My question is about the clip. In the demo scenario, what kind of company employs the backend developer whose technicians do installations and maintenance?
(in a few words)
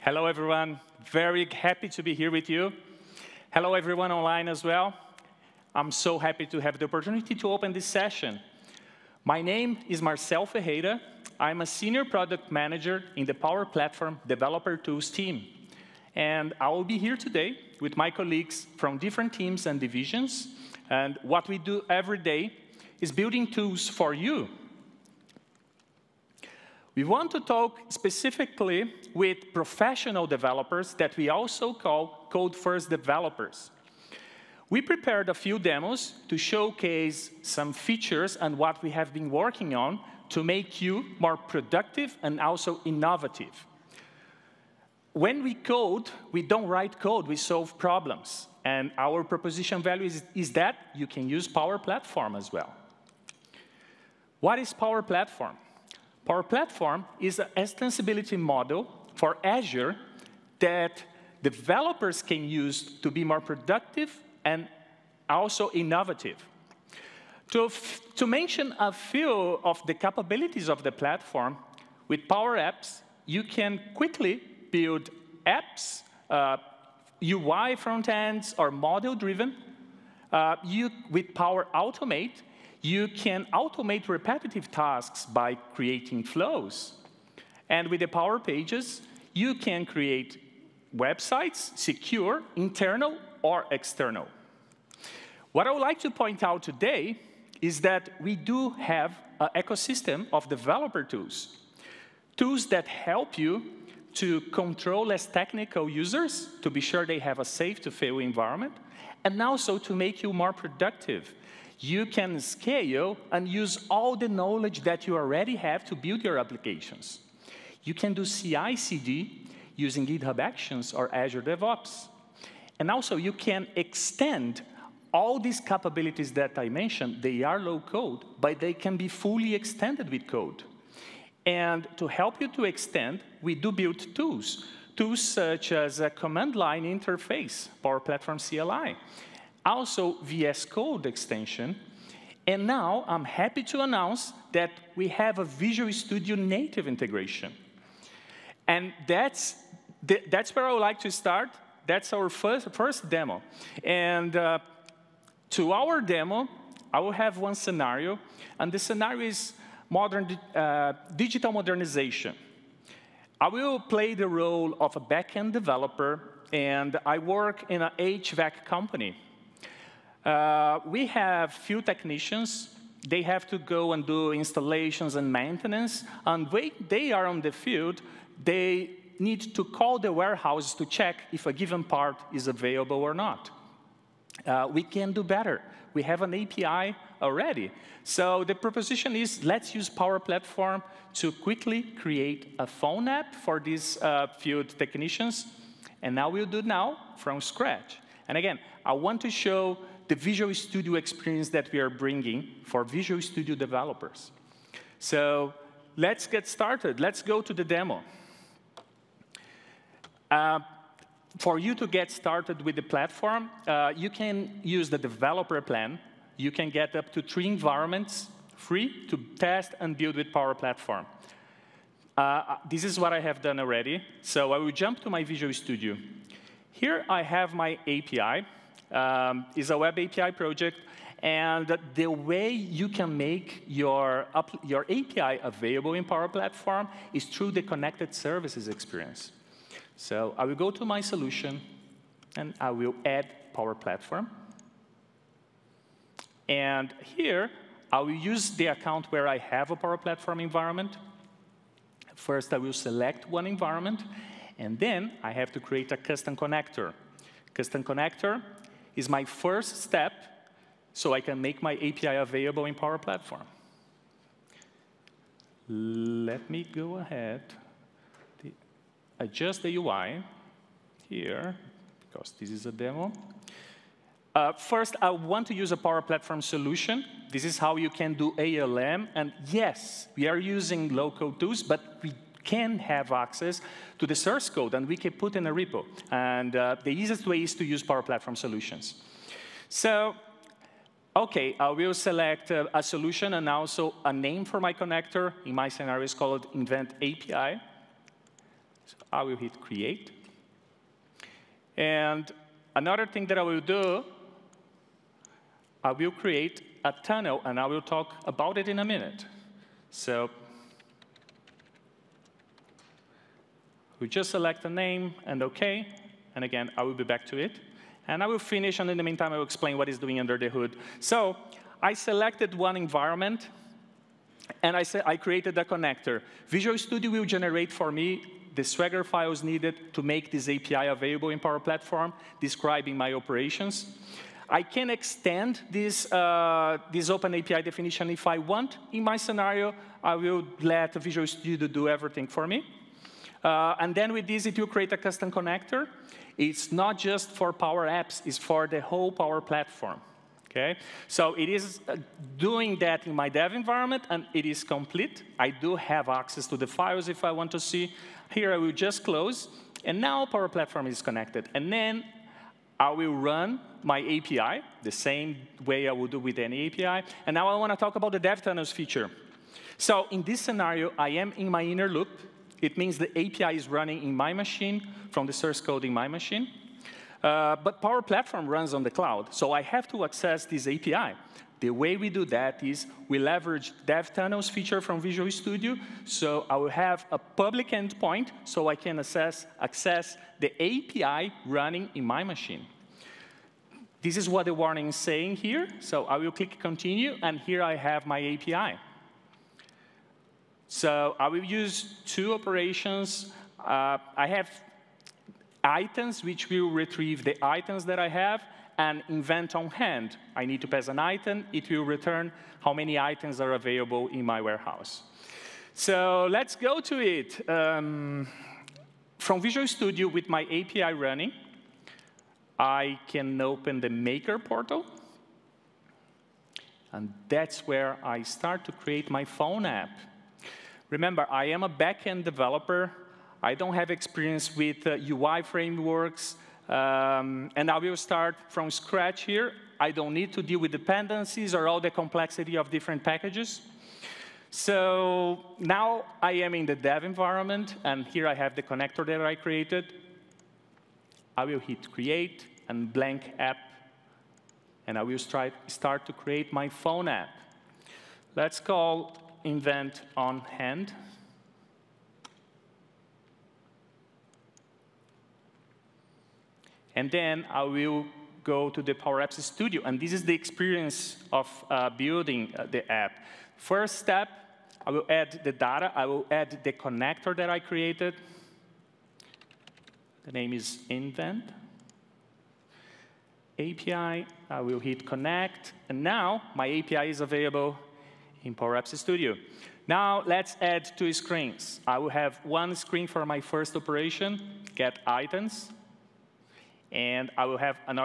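HVAC.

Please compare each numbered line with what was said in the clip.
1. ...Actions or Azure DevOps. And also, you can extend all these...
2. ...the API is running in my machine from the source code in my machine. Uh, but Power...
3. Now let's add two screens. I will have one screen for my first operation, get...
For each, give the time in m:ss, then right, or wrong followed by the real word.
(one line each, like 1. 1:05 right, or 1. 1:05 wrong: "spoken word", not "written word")
1. 2:00 right
2. 6:12 right
3. 8:09 right.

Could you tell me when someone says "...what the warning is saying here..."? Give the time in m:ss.
6:34.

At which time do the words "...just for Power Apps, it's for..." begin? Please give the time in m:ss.
5:46.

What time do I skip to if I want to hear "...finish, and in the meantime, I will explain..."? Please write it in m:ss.
5:18.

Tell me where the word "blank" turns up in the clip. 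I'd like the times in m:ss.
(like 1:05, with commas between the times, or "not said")
7:32.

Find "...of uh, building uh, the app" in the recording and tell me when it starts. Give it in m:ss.
7:51.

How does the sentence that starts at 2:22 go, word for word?
And now I'm happy to announce that we have a Visual Studio native integration.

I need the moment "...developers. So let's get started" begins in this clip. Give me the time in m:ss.
3:23.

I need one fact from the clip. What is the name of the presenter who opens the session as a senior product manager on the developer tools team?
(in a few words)
Marcel Ferreira.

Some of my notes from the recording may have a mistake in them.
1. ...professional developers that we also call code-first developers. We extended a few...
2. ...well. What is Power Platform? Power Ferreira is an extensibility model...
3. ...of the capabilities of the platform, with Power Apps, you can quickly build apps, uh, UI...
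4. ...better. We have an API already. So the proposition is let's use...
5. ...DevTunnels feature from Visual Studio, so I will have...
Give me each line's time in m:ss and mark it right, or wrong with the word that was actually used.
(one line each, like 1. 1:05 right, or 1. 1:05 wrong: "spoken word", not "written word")
1. 0:29 wrong: "prepared", not "extended"
2. 0:52 wrong: "Platform", not "Ferreira"
3. 1:09 right
4. 3:05 right
5. 6:23 right.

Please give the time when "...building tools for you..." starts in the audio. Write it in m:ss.
0:23.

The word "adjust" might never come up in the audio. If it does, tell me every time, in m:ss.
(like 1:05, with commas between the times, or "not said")
4:29.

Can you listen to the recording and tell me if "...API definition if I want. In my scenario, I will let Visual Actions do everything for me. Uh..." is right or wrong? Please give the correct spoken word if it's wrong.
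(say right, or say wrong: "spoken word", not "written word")
wrong: "Studio", not "Actions".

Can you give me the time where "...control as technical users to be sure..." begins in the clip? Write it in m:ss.
1:44.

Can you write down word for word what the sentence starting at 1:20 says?
Uh, you, with Power Automate, you can automate repetitive tasks by creating flows.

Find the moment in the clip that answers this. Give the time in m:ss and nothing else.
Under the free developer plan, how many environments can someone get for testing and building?
3:37.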